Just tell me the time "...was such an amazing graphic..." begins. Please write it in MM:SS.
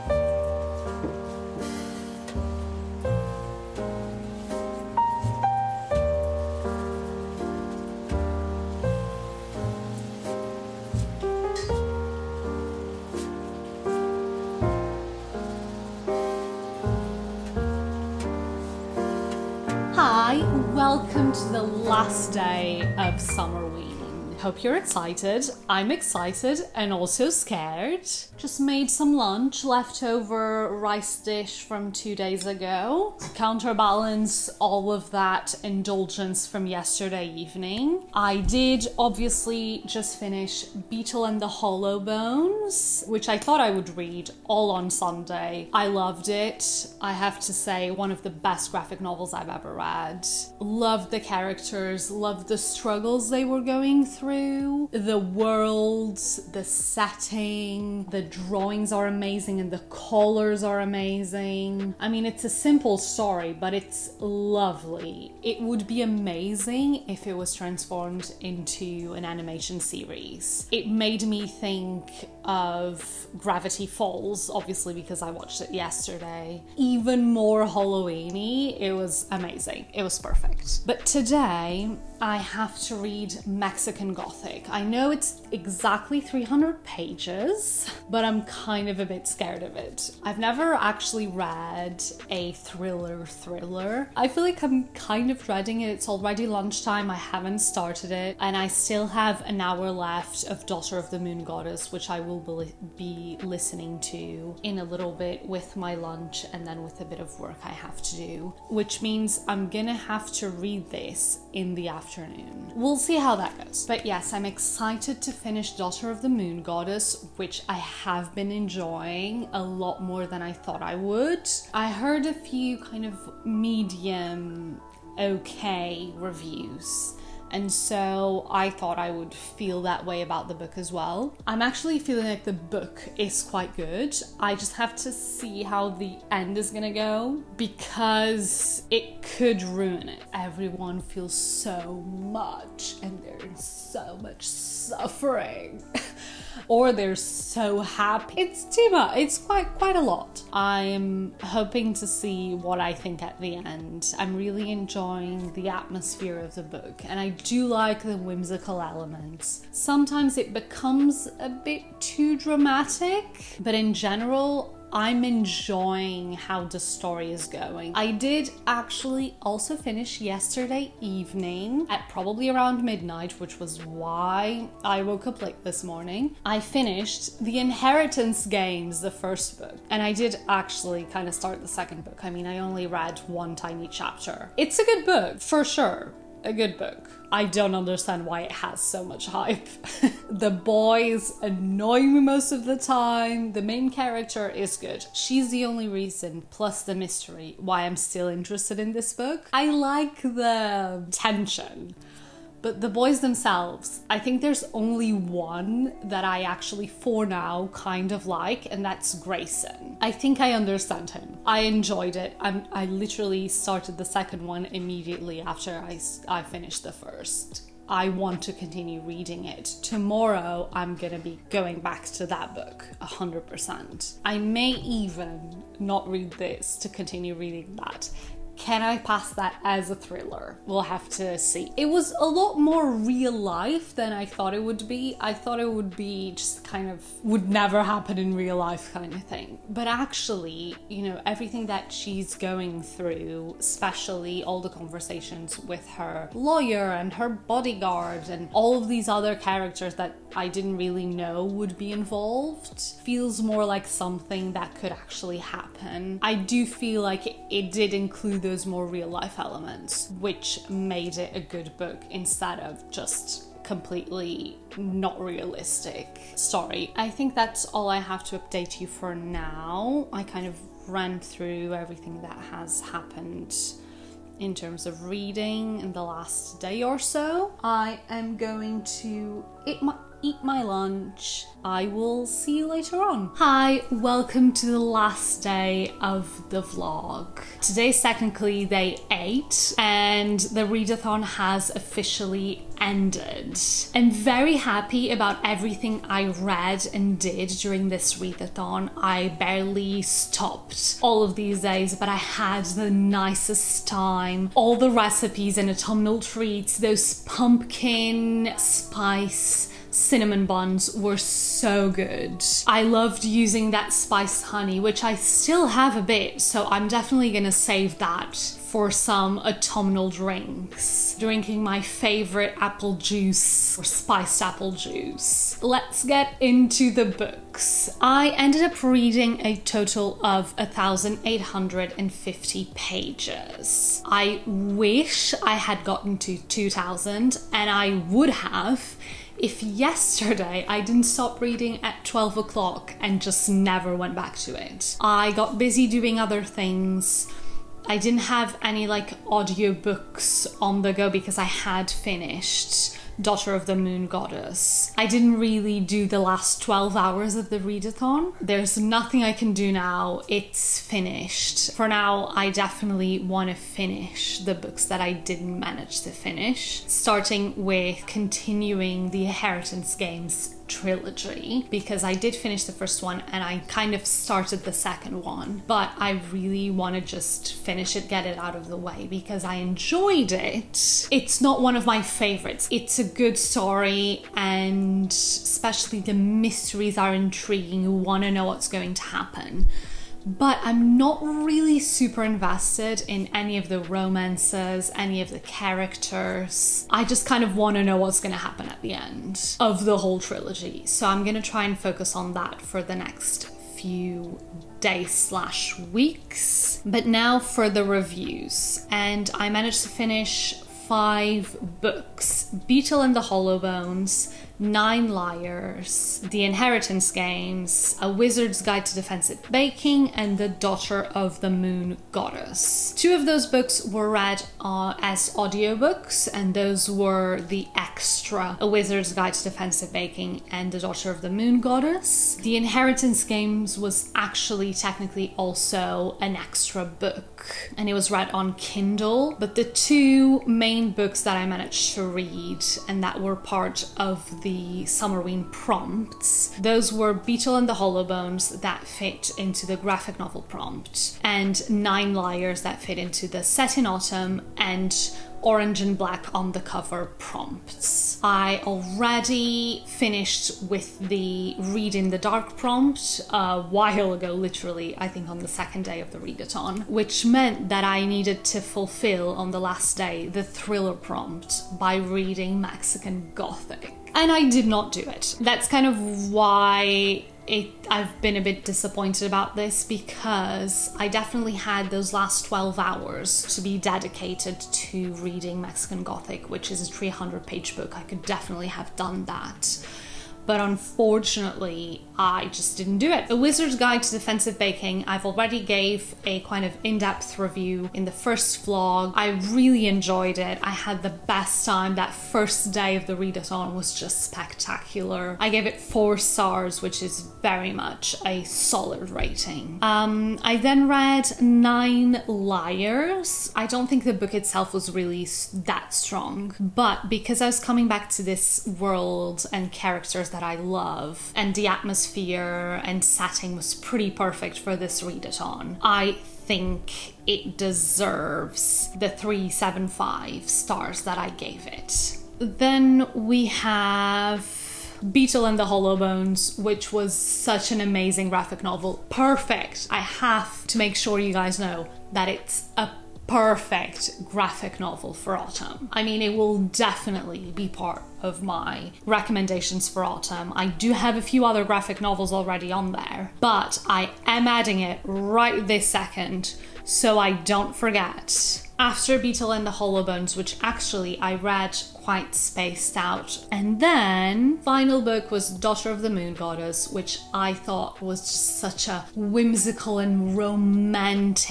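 08:56.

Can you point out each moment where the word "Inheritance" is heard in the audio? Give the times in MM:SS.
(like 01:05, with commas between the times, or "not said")
02:57, 06:09, 06:56, 07:12.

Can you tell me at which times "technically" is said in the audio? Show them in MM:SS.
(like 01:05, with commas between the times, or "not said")
04:48, 07:14.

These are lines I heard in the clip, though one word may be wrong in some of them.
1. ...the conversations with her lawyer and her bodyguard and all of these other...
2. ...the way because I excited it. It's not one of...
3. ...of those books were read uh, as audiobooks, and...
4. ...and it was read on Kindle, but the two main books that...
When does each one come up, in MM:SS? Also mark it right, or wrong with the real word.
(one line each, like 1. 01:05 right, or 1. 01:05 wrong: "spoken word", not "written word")
1. 04:04 right
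2. 06:18 wrong: "enjoyed", not "excited"
3. 07:03 right
4. 07:17 right.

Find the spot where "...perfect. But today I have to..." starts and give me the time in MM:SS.
01:20.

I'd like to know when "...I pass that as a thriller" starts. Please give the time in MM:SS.
03:48.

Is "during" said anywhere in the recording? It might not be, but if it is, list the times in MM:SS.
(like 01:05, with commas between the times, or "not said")
04:57.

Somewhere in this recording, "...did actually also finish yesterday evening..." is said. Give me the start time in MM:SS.
02:48.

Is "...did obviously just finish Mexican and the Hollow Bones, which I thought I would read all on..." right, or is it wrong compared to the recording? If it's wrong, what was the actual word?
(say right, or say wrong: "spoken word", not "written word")
wrong: "Beetle", not "Mexican".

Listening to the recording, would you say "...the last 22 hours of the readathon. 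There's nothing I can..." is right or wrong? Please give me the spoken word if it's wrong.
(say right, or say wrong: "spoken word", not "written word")
wrong: "12", not "22".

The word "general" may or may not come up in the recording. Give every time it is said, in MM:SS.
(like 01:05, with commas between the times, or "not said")
02:43.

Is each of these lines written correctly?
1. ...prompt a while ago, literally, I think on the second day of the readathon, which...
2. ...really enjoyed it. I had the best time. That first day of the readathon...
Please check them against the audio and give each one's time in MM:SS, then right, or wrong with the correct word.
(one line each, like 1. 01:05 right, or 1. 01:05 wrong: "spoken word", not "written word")
1. 07:42 right
2. 08:19 right.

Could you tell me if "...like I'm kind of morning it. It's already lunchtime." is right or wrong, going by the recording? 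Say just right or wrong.
wrong.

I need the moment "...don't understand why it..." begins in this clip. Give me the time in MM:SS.
03:07.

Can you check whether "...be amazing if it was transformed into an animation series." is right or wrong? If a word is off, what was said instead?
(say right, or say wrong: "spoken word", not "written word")
right.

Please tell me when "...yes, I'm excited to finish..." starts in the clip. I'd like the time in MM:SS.
01:54.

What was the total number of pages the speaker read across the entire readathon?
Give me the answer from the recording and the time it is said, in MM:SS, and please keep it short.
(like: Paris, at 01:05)
1,850, at 05:30.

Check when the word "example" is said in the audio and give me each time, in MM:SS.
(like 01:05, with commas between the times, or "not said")
not said.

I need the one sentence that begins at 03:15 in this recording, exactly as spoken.
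She's the only reason, plus the mystery, why I'm still interested in this book.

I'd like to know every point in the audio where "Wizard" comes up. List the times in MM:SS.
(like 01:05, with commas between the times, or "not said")
06:58, 07:08, 08:13.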